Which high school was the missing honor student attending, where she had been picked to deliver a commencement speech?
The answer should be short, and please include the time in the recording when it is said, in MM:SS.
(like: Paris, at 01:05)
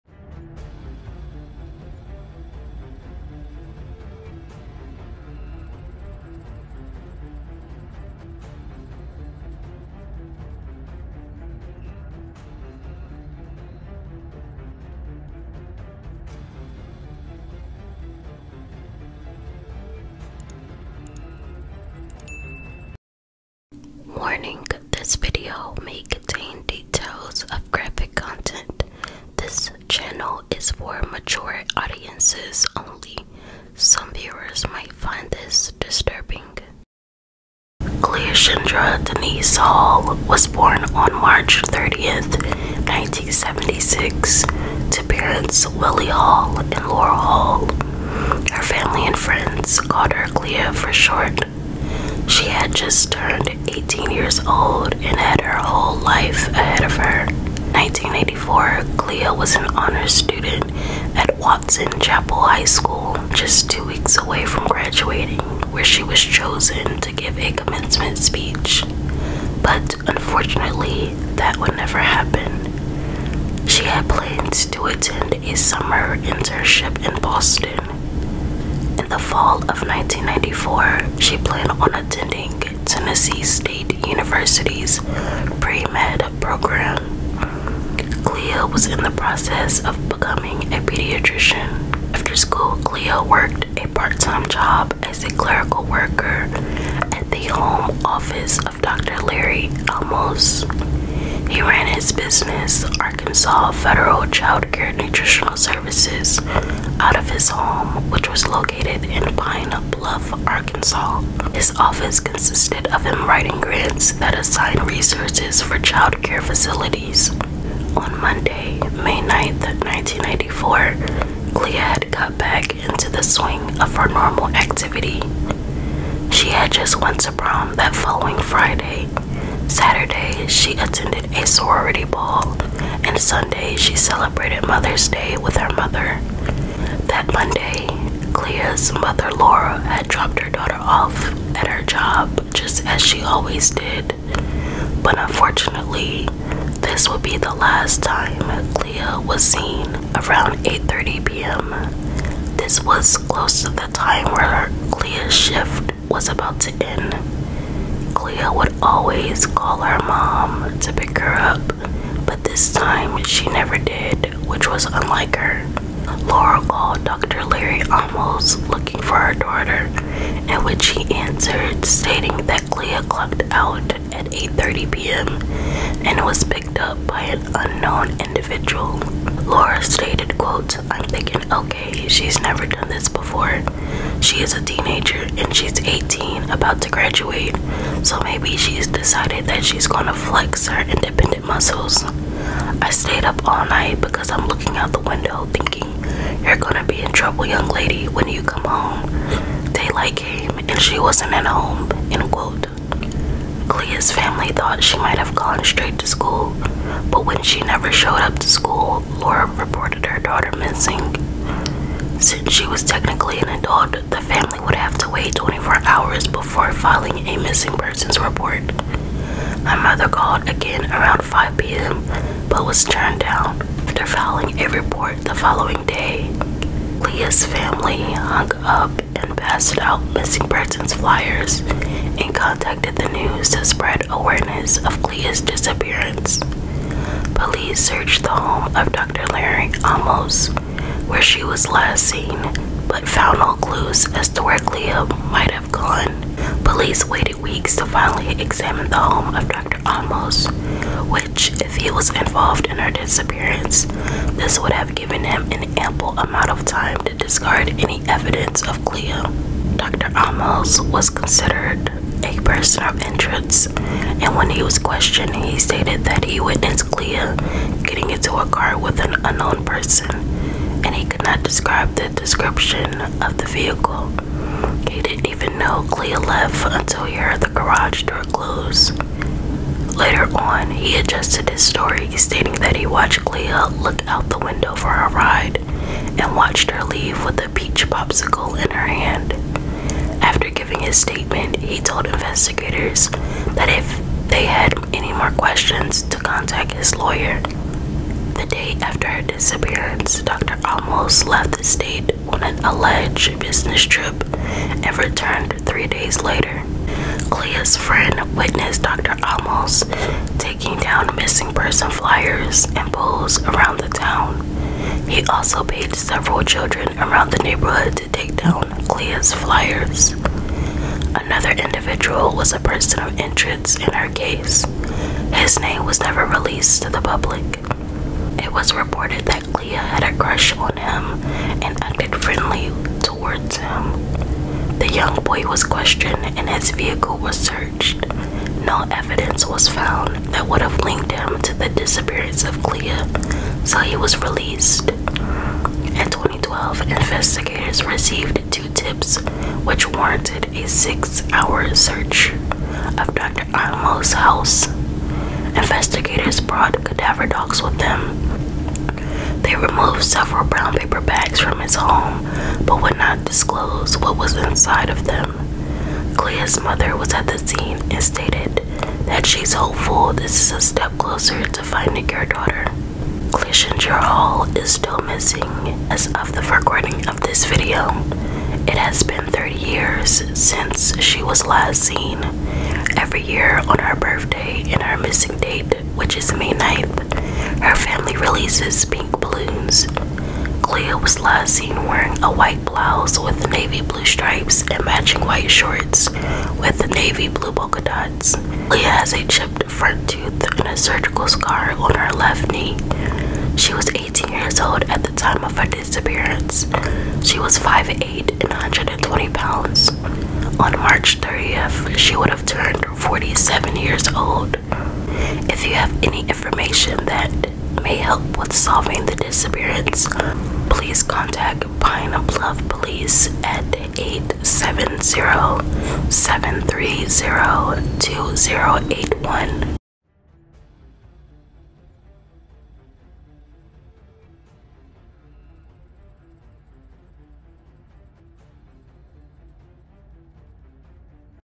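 Watson Chapel High School, at 01:01.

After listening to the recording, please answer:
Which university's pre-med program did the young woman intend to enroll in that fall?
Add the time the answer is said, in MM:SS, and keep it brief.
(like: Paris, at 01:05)
Tennessee State University, at 01:22.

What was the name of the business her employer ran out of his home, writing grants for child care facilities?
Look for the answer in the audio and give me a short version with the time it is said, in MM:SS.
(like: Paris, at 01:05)
Arkansas Federal Child Care Nutritional Services, at 01:43.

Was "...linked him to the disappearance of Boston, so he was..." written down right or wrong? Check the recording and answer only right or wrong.
wrong.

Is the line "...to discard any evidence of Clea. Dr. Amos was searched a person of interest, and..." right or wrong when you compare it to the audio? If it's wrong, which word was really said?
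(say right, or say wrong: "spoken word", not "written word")
wrong: "considered", not "searched".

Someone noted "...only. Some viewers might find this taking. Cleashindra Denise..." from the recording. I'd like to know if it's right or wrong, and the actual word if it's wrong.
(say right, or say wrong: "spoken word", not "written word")
wrong: "disturbing", not "taking".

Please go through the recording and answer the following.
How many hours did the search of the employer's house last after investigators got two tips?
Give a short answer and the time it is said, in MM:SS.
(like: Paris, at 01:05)
6, at 05:50.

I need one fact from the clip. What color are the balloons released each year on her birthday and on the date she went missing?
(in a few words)
Pink.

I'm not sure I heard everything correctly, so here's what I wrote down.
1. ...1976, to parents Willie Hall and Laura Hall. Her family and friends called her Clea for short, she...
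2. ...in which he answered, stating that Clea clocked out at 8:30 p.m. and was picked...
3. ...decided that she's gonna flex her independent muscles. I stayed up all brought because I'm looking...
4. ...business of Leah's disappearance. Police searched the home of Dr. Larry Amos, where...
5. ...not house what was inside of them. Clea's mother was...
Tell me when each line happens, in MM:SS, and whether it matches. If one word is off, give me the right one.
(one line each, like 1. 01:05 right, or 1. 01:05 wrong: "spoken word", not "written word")
1. 00:42 right
2. 02:50 right
3. 03:08 wrong: "night", not "brought"
4. 03:54 wrong: "awareness", not "business"
5. 06:02 wrong: "disclose", not "house".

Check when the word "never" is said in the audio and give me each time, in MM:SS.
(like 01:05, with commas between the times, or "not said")
01:11, 02:43, 03:02, 03:27, 05:26.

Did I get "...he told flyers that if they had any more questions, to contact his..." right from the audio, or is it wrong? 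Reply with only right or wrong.
wrong.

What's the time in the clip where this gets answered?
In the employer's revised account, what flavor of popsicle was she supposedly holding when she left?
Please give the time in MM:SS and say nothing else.
04:47.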